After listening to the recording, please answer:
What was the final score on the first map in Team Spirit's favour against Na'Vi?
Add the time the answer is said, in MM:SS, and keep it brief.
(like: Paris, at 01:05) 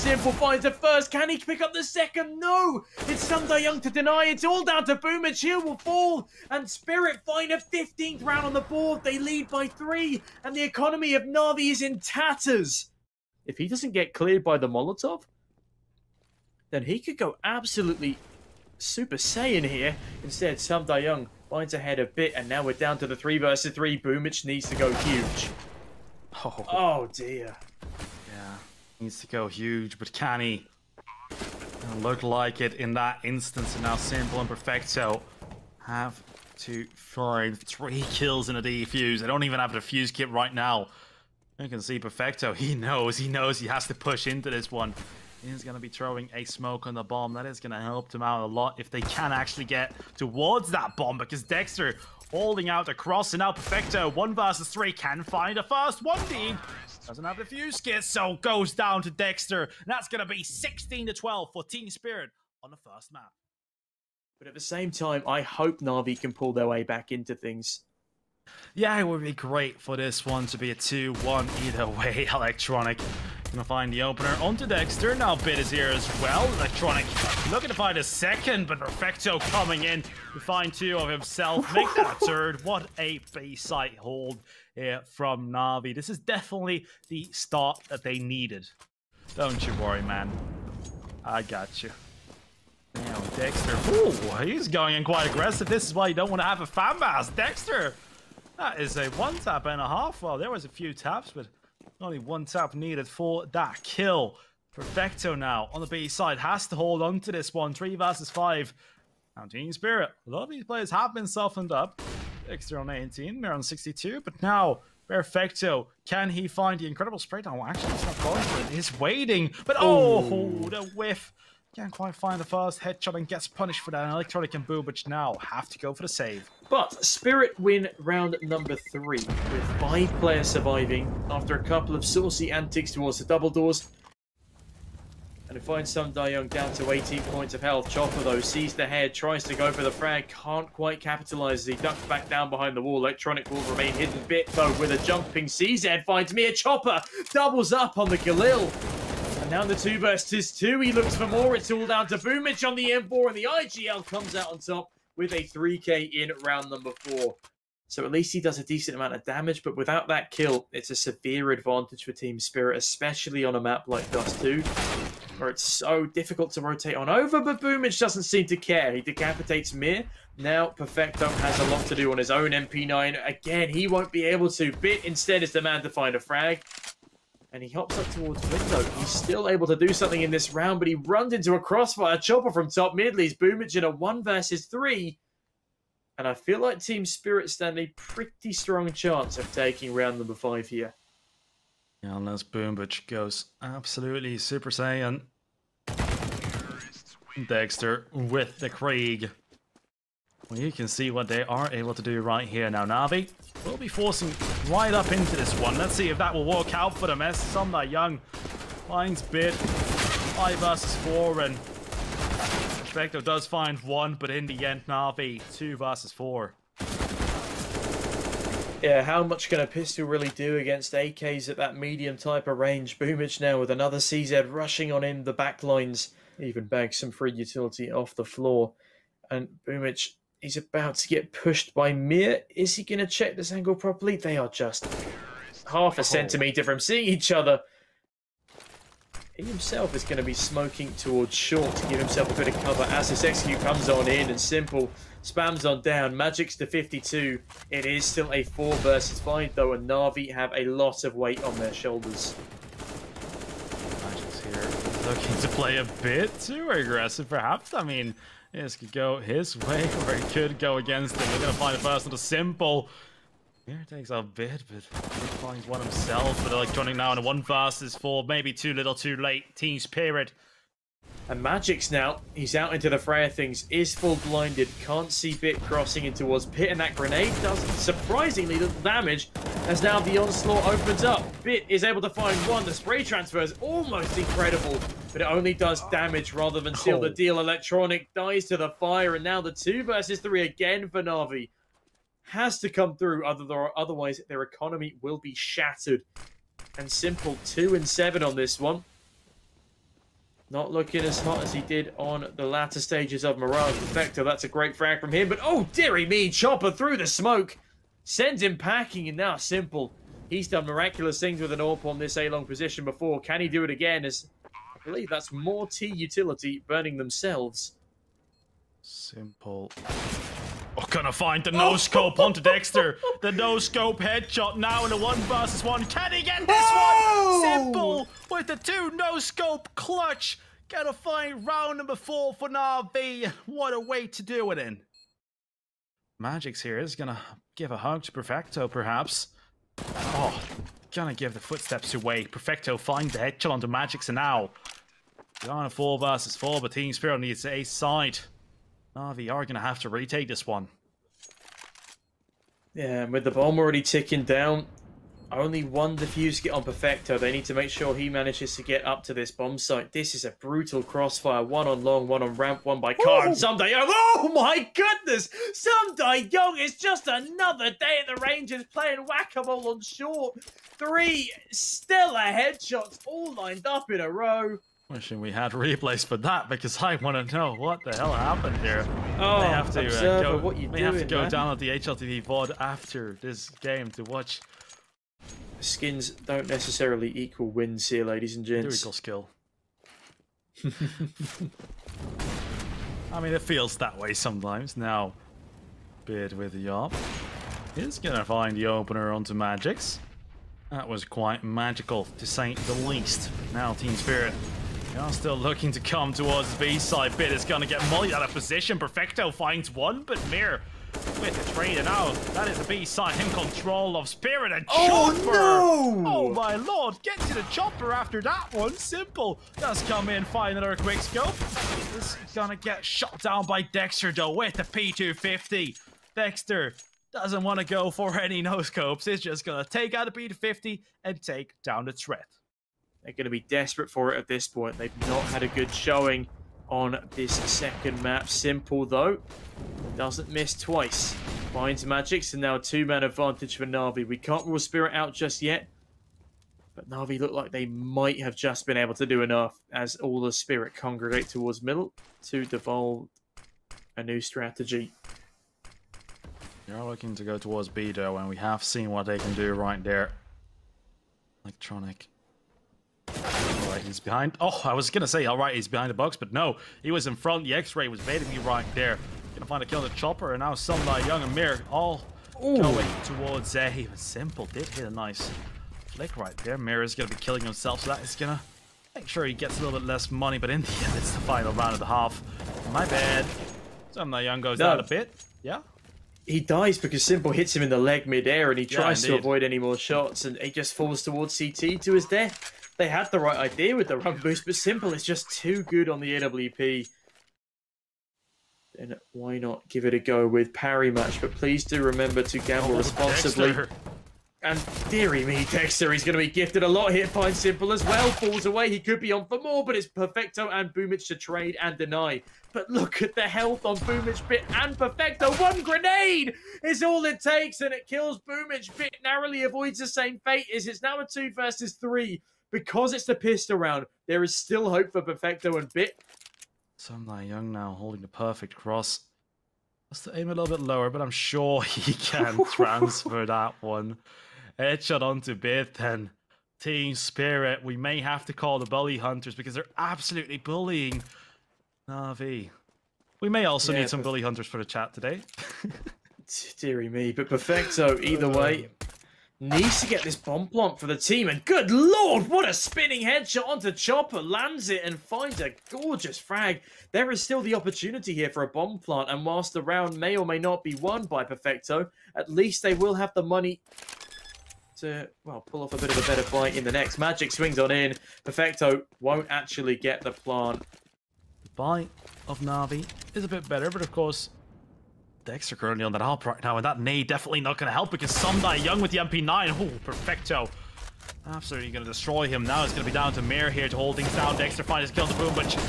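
16 to 12, at 01:00.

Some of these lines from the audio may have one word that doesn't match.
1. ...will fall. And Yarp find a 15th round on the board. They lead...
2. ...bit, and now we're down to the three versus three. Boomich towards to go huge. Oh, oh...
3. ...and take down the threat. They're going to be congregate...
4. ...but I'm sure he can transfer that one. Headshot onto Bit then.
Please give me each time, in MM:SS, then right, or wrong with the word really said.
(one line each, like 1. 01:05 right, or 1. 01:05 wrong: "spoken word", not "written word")
1. 00:05 wrong: "Spirit", not "Yarp"
2. 00:22 wrong: "needs", not "towards"
3. 07:11 wrong: "desperate", not "congregate"
4. 08:50 right.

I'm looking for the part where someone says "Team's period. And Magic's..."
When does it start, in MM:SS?
04:29.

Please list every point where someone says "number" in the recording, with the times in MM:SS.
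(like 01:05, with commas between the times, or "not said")
02:08, 02:36, 03:10, 05:31.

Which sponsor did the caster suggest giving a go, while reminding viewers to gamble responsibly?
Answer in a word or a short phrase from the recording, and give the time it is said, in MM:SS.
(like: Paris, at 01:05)
Parimatch, at 08:20.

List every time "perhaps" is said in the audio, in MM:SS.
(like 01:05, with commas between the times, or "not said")
04:17, 05:38.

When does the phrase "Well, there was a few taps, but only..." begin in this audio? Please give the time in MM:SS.
01:40.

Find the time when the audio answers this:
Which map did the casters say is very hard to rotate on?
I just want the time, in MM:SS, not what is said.
02:44.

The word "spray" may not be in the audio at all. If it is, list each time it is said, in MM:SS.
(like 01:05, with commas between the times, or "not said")
01:57, 04:42.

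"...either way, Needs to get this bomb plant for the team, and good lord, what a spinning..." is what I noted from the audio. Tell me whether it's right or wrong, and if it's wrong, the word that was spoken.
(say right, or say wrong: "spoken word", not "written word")
right.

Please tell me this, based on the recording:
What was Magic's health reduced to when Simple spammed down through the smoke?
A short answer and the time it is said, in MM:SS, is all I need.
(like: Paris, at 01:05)
52, at 04:06.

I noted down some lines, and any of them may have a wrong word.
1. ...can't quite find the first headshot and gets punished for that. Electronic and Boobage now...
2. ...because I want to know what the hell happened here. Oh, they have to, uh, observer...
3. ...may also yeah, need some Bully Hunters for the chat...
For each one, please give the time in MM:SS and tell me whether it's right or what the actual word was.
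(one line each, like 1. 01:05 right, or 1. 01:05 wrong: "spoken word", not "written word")
1. 02:01 right
2. 06:16 right
3. 09:03 right.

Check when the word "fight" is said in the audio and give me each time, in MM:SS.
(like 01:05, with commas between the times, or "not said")
09:26.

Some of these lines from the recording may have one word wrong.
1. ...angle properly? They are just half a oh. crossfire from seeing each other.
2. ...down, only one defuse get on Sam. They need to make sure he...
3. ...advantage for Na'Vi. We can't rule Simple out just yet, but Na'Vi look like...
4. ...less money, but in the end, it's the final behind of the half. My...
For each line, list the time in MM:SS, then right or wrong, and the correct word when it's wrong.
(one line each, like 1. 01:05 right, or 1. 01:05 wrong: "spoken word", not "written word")
1. 03:53 wrong: "centimetre", not "crossfire"
2. 05:54 wrong: "Perfecto", not "Sam"
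3. 07:23 wrong: "Spirit", not "Simple"
4. 07:59 wrong: "round", not "behind".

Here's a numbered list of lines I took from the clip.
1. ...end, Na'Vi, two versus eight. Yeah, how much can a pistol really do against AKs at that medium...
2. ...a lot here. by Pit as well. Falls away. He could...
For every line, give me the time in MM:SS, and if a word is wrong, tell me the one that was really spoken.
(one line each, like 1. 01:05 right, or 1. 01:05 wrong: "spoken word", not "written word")
1. 03:34 wrong: "four", not "eight"
2. 08:26 wrong: "Simple", not "Pit".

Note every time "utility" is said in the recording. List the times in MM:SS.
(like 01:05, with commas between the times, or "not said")
03:47, 05:15.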